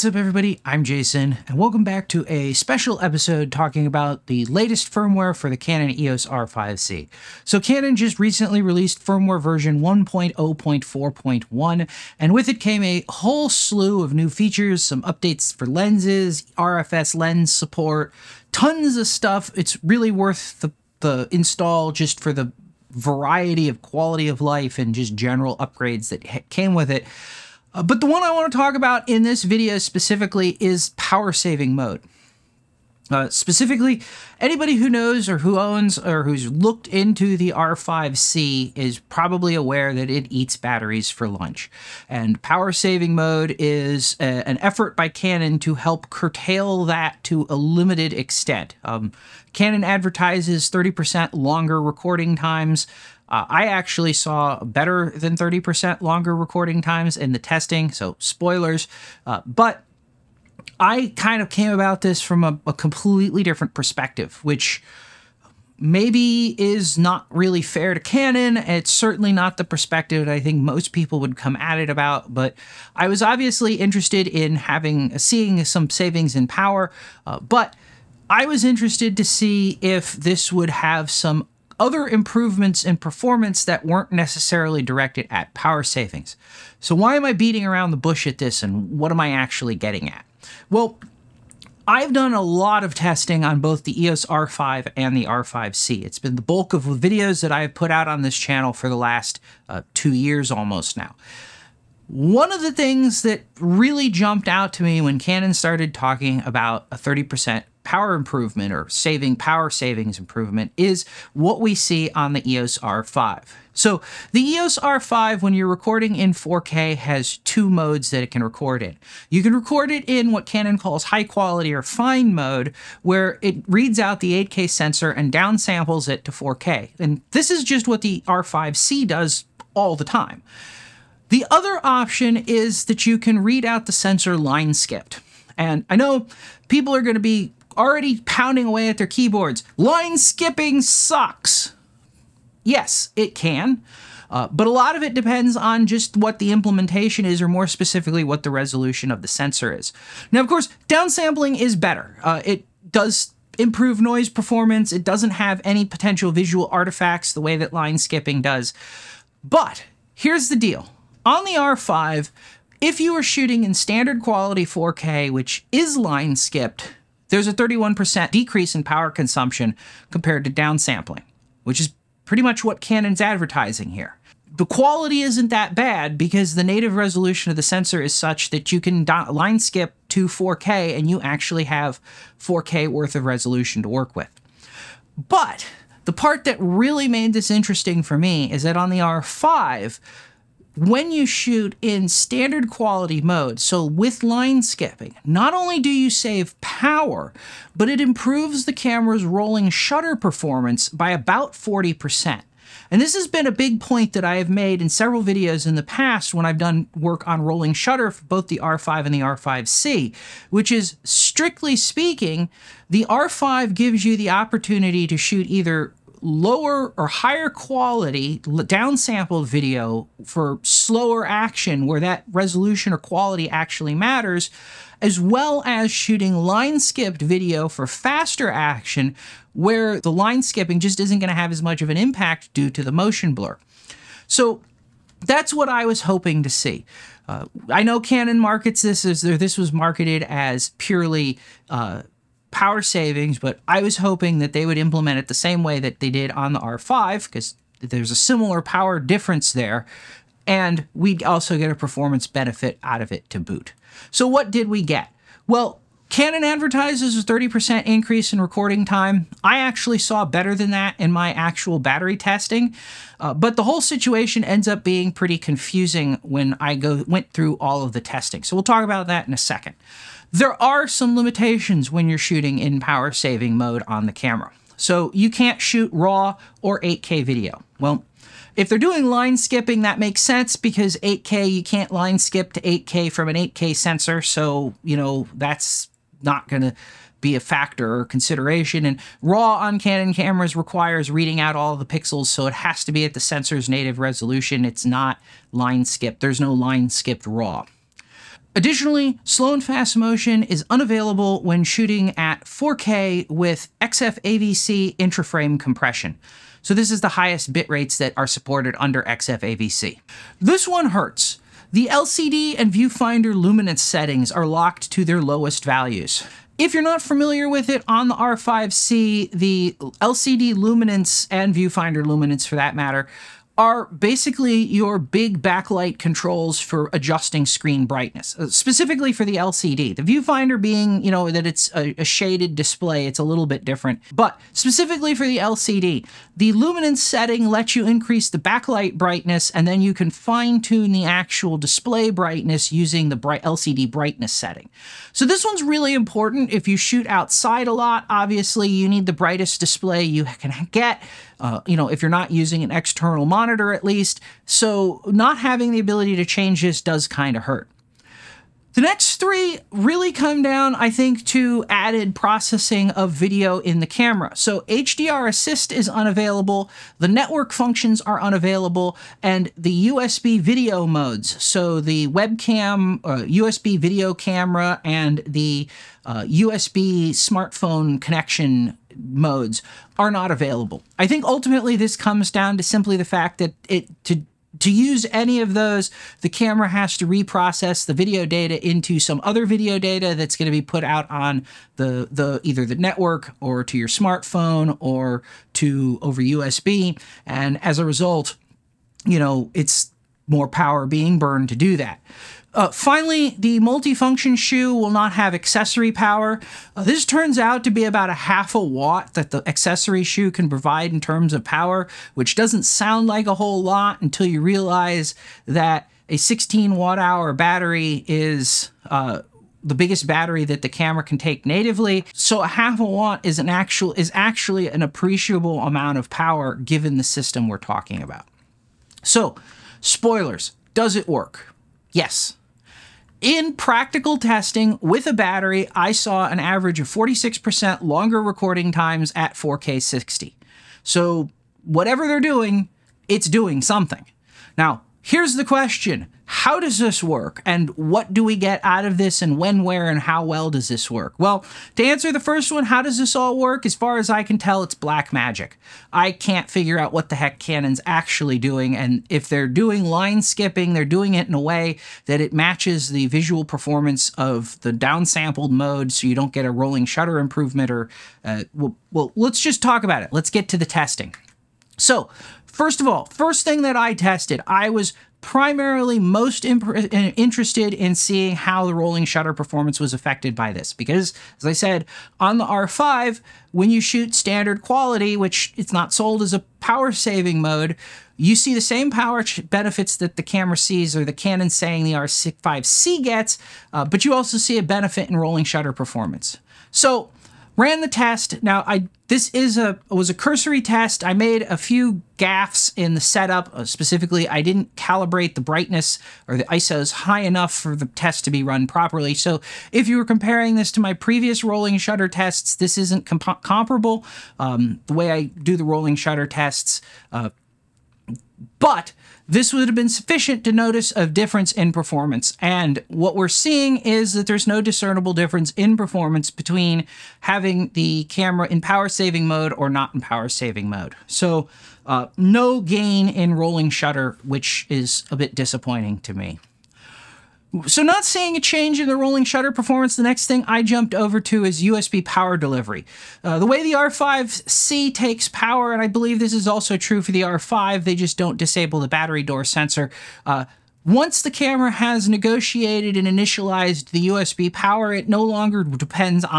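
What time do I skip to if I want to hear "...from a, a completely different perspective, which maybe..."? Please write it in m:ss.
1:02.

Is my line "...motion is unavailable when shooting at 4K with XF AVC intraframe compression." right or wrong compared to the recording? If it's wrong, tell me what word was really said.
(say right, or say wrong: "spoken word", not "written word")
right.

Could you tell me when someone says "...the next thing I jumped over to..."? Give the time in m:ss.
8:59.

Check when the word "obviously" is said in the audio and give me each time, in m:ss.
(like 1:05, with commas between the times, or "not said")
1:13, 5:48.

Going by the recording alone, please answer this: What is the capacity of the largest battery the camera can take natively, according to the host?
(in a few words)
16 watt hours.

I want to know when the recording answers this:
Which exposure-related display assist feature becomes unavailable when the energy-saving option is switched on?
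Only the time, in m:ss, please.
6:04.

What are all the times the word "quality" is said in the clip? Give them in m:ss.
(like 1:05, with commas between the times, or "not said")
0:23, 2:01, 2:44, 2:54, 3:12, 3:37, 3:42, 8:04.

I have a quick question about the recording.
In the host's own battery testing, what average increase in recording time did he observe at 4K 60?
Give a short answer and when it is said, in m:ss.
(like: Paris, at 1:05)
46%, at 7:16.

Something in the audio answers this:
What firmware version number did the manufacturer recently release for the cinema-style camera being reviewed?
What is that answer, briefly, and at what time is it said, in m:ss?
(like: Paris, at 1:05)
1.0.4.1, at 0:09.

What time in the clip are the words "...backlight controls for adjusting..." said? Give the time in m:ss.
5:25.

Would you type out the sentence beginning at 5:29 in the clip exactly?
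The viewfinder being, you know, that it's a, a, shaded display, it's a little bit different.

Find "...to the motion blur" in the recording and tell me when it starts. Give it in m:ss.
3:52.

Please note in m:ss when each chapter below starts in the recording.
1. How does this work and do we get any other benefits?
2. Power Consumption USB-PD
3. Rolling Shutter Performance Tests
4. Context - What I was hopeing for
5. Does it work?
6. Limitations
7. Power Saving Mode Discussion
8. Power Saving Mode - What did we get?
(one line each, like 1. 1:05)
1. 7:25
2. 8:55
3. 7:51
4. 0:59
5. 7:07
6. 4:29
7. 0:43
8. 4:13.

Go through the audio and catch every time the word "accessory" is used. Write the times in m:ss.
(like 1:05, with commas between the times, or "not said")
6:45, 6:49.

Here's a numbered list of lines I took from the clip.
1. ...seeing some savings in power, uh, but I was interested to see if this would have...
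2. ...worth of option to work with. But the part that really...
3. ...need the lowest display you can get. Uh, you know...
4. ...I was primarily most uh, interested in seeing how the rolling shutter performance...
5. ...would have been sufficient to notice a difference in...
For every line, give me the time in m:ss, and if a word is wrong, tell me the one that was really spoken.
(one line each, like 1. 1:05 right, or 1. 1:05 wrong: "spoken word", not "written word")
1. 1:15 right
2. 3:02 wrong: "resolution", not "option"
3. 5:48 wrong: "brightest", not "lowest"
4. 7:54 right
5. 8:39 right.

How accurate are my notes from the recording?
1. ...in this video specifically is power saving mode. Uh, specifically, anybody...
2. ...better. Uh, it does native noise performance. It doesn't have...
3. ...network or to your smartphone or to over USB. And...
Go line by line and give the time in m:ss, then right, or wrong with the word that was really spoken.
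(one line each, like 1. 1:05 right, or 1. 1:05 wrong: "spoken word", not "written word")
1. 0:29 right
2. 2:31 wrong: "improve", not "native"
3. 6:32 right.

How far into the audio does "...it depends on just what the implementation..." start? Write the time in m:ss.
2:25.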